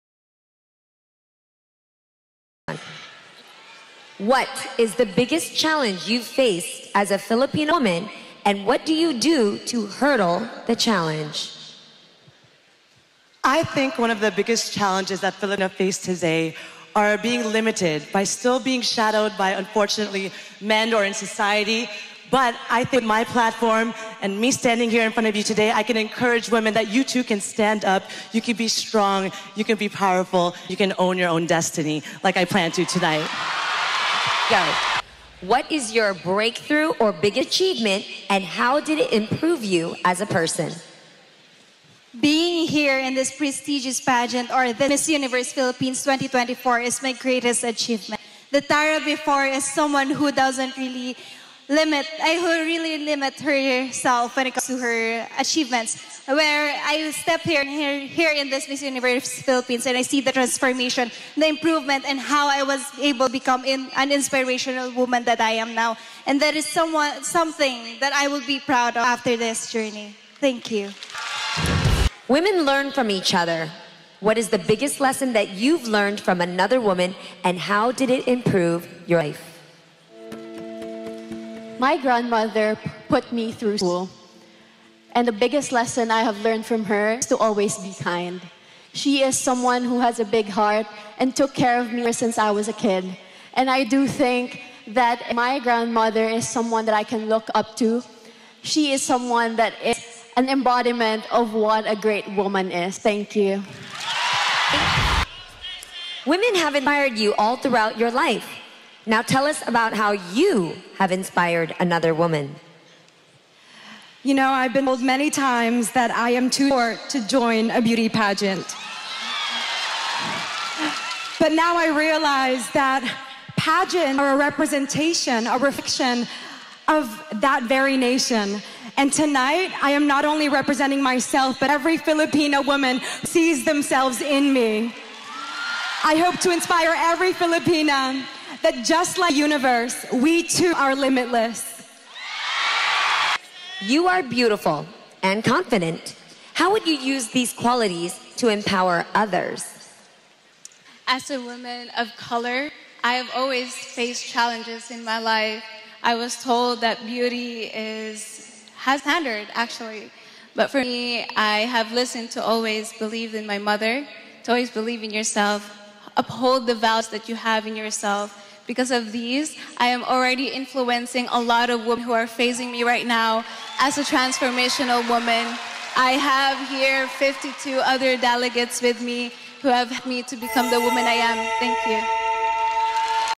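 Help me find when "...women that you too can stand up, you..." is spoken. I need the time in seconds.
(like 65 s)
26 s.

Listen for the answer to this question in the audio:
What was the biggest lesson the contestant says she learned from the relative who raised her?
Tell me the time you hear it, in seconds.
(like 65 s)
87 s.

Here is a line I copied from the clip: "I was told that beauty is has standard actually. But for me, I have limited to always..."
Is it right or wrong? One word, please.
wrong.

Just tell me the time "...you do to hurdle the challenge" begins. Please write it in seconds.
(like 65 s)
8 s.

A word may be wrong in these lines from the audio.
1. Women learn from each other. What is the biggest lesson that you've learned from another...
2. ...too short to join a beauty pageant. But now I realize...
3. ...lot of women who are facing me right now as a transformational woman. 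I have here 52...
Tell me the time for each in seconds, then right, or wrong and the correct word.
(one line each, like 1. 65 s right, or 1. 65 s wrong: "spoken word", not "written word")
1. 72 s right
2. 116 s right
3. 171 s right.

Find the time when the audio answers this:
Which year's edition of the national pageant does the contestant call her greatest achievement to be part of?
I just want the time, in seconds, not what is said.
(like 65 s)
46 s.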